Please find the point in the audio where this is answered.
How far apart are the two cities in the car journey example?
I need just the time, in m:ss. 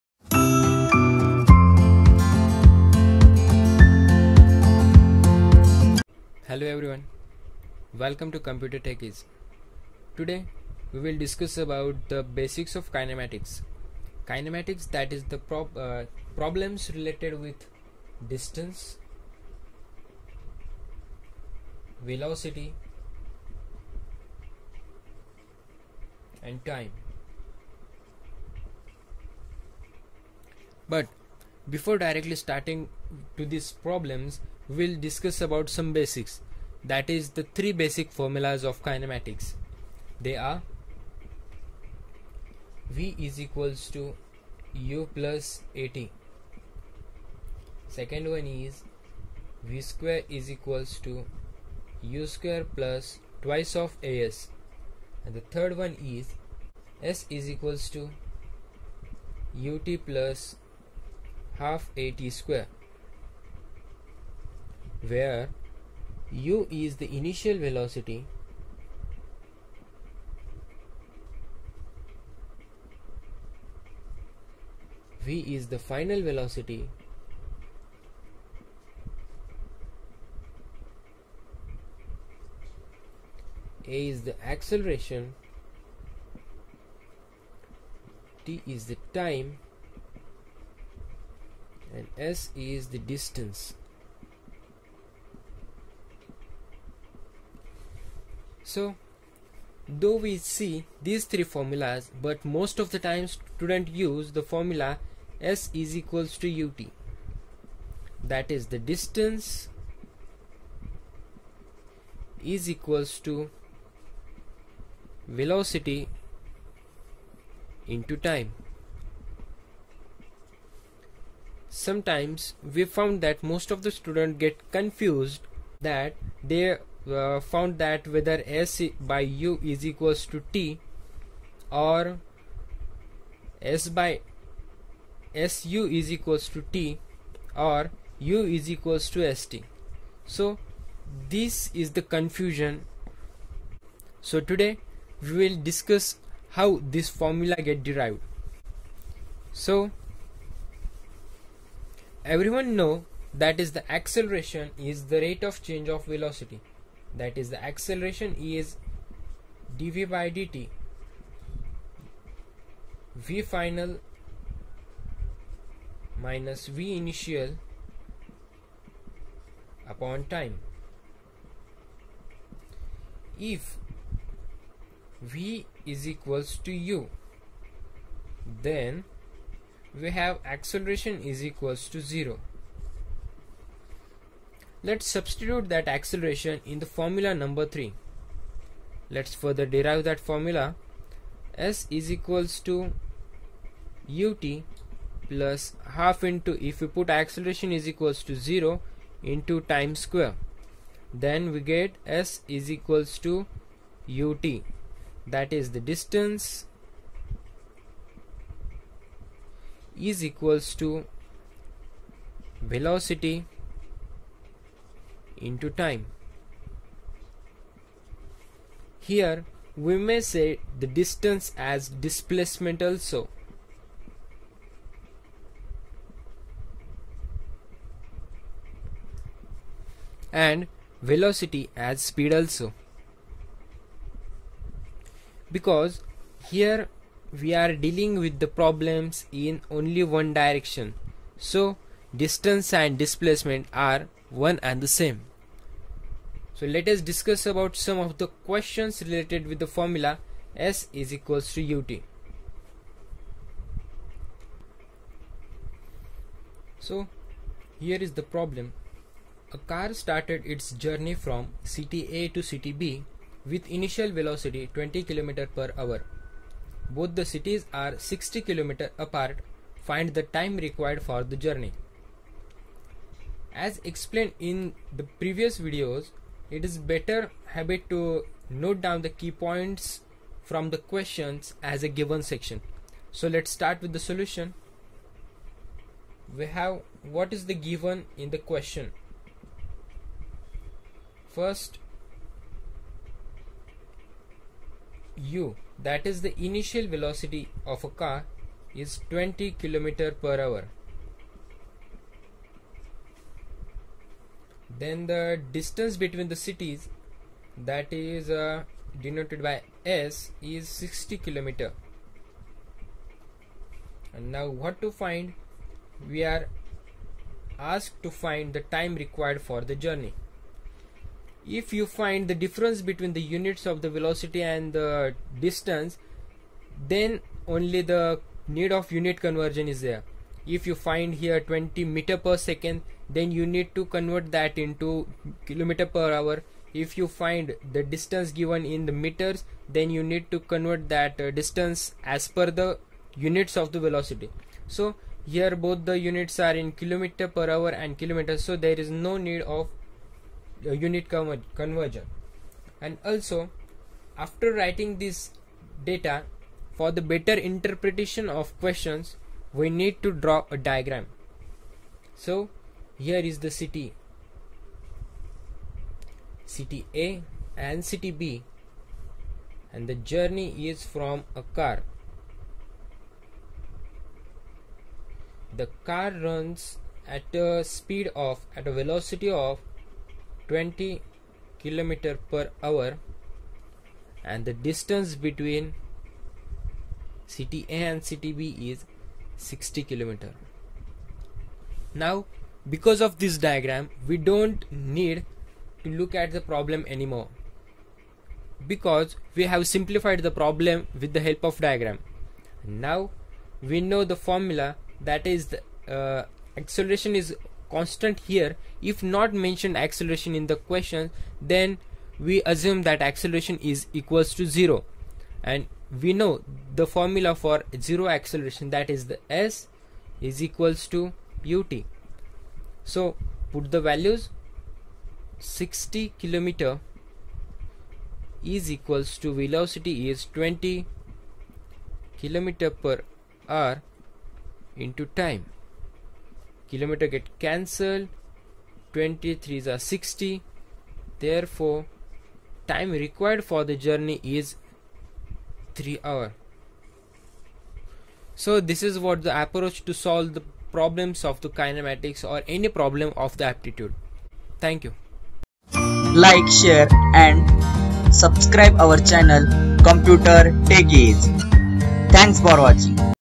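4:27.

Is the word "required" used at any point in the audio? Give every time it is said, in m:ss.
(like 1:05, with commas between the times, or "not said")
4:30, 5:19, 7:23.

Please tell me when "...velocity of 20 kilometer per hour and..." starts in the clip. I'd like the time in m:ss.
6:18.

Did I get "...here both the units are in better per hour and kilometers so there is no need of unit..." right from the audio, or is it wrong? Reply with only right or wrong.
wrong.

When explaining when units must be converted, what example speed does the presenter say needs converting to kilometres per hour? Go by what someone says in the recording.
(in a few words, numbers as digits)
20 meter per second.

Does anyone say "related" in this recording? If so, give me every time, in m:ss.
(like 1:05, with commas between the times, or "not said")
0:16, 4:09.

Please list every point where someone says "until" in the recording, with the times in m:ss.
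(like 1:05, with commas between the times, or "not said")
not said.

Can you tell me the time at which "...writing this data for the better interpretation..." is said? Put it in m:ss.
5:54.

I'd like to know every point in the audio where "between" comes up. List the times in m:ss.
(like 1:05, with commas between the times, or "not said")
5:06, 5:22, 6:25.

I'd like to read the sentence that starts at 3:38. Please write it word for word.
Here we may say the distance as displacement also.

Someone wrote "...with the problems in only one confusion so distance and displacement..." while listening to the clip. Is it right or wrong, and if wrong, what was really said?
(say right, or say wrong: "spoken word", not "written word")
wrong: "direction", not "confusion".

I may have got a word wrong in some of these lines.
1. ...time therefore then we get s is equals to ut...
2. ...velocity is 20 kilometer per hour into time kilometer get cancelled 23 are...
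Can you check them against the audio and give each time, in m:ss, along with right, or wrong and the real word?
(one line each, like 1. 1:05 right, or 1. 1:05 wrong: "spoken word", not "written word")
1. 3:19 wrong: "square", not "therefore"
2. 7:09 right.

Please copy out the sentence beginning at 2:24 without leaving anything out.
So today we will discuss how this formula get derived.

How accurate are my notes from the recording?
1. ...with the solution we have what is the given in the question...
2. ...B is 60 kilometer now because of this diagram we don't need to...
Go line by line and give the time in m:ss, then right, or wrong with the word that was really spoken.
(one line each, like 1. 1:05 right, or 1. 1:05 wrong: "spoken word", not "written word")
1. 4:43 right
2. 6:28 right.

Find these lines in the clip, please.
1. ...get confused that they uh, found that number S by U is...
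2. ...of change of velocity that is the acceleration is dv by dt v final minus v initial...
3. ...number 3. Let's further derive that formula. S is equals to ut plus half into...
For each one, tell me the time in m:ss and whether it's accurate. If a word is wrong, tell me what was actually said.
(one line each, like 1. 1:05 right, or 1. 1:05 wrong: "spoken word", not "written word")
1. 2:04 wrong: "whether", not "number"
2. 2:35 right
3. 3:07 right.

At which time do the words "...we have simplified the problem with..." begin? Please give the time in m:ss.
6:39.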